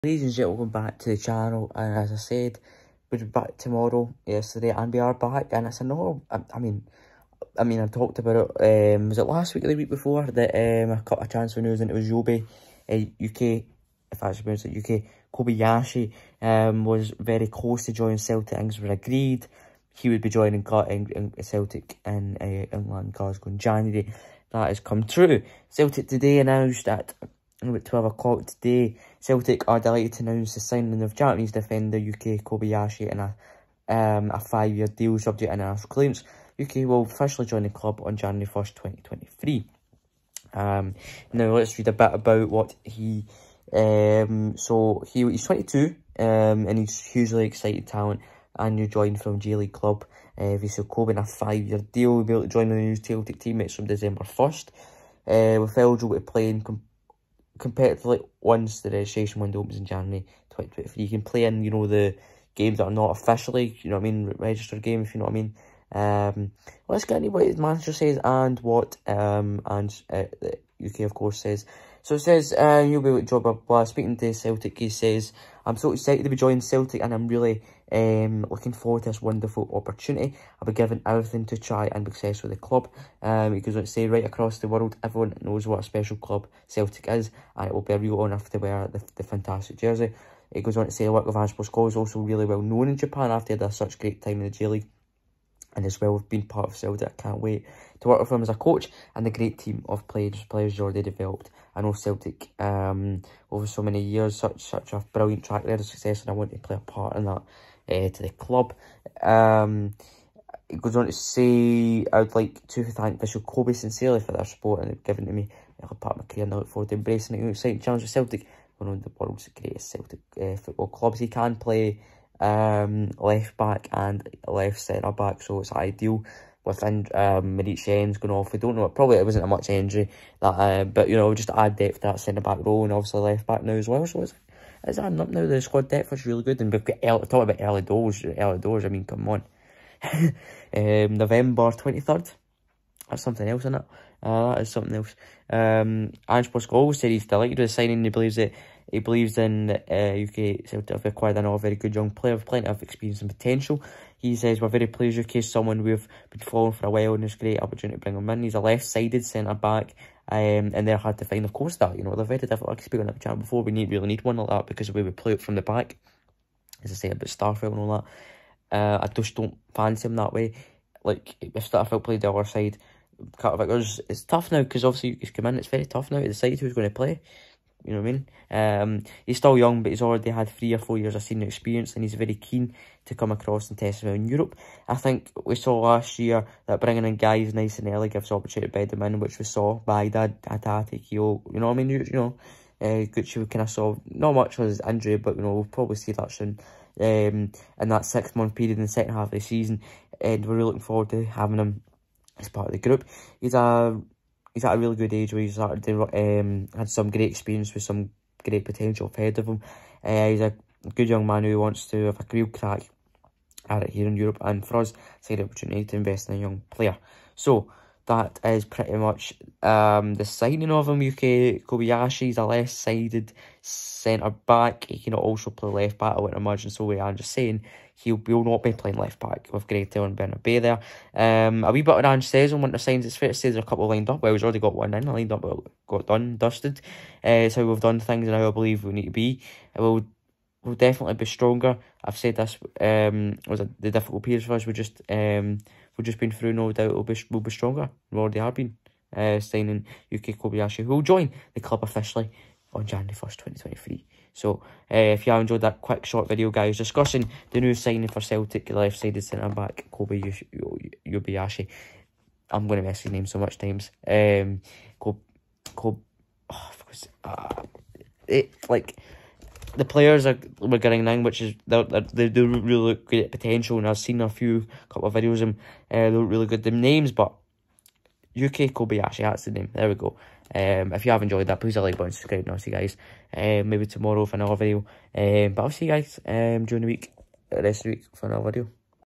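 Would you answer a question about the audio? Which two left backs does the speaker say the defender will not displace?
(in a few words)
Gretel and Bernabei.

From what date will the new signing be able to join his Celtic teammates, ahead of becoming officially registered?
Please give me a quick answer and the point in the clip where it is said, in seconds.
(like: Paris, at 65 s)
December 1st, at 53 s.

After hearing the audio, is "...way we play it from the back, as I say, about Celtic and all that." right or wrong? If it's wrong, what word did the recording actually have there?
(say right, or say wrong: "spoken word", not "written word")
wrong: "Starfelt", not "Celtic".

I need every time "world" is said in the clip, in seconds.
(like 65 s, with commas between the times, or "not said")
84 s, 119 s.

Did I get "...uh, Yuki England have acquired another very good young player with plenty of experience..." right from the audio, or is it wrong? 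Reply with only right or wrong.
wrong.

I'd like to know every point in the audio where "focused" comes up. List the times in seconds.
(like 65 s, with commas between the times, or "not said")
not said.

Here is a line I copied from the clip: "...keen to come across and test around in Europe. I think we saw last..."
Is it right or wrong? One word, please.
right.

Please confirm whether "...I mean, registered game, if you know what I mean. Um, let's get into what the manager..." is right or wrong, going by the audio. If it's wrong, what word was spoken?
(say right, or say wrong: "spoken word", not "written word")
right.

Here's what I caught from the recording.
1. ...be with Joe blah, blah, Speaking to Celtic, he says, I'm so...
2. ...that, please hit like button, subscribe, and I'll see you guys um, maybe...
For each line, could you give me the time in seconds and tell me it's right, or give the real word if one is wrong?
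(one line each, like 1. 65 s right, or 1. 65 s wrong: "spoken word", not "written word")
1. 73 s right
2. 281 s right.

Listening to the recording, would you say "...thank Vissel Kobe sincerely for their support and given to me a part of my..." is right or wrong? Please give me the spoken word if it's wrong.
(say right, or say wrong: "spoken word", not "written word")
right.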